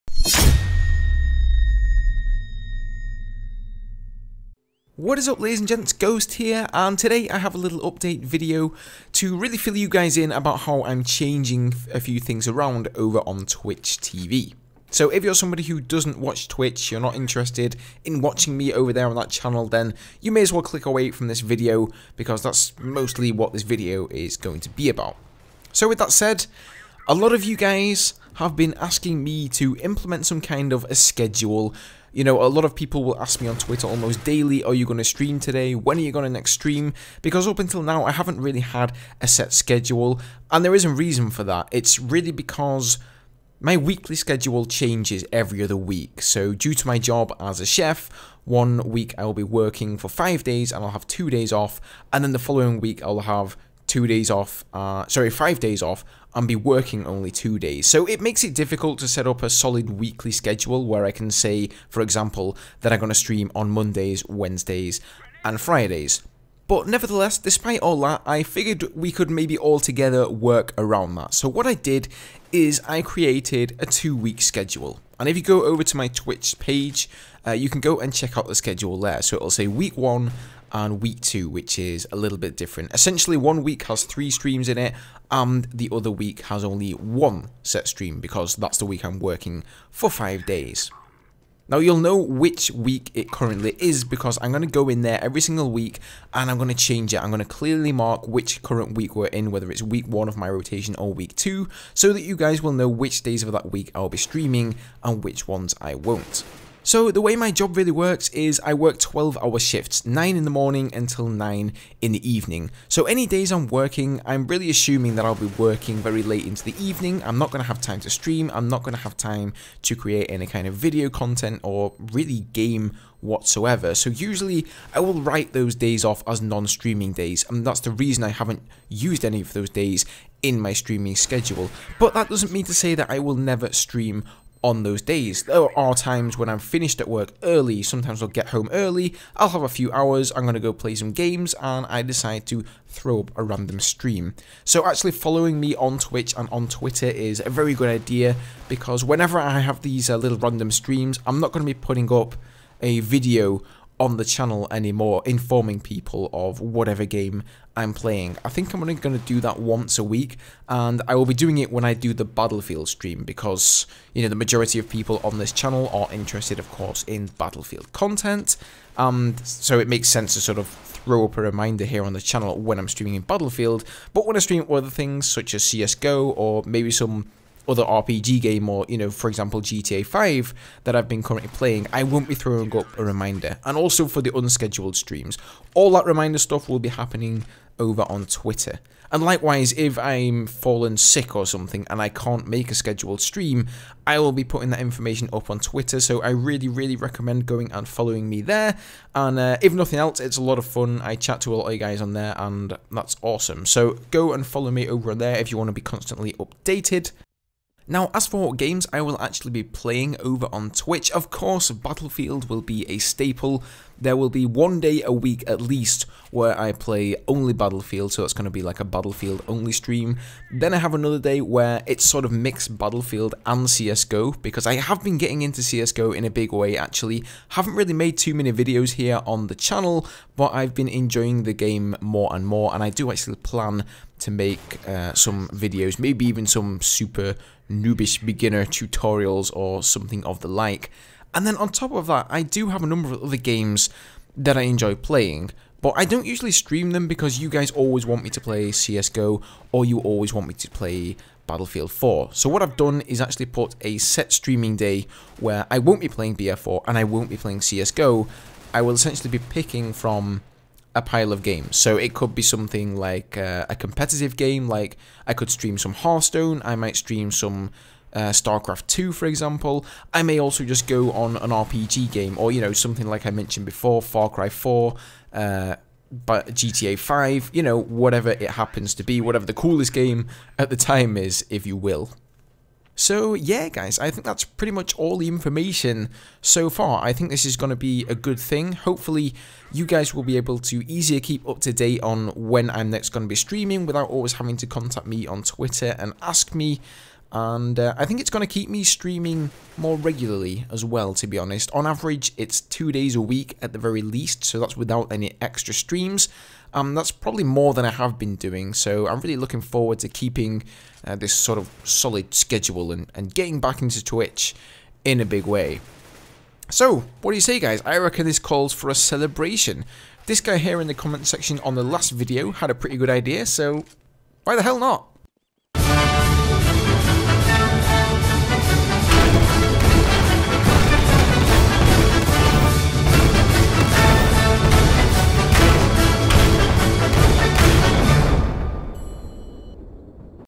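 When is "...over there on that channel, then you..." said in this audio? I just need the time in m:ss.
0:18.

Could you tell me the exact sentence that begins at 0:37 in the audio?
Because up until now, I haven't really had a set schedule, and there is a reason for that.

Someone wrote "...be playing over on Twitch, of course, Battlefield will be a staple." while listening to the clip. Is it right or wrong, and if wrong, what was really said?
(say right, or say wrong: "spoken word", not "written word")
right.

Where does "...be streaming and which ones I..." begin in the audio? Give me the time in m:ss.
1:44.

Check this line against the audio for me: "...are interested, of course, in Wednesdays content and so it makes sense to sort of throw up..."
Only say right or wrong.
wrong.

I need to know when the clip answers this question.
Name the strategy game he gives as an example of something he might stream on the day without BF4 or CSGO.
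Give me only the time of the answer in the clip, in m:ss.
4:28.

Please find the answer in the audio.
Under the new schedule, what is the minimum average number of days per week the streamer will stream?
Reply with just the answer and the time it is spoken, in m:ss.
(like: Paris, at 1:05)
2, at 5:02.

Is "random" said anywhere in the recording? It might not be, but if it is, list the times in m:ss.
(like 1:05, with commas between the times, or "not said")
2:23, 2:30.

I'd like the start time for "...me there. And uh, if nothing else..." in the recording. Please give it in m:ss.
3:18.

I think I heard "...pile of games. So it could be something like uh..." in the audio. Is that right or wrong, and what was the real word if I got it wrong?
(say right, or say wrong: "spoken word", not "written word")
right.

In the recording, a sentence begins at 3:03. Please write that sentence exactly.
And also for the unscheduled streams.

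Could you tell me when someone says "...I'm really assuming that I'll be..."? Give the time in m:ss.
1:54.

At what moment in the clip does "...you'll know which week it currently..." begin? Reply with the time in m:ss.
1:31.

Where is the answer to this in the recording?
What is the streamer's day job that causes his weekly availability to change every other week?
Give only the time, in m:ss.
0:47.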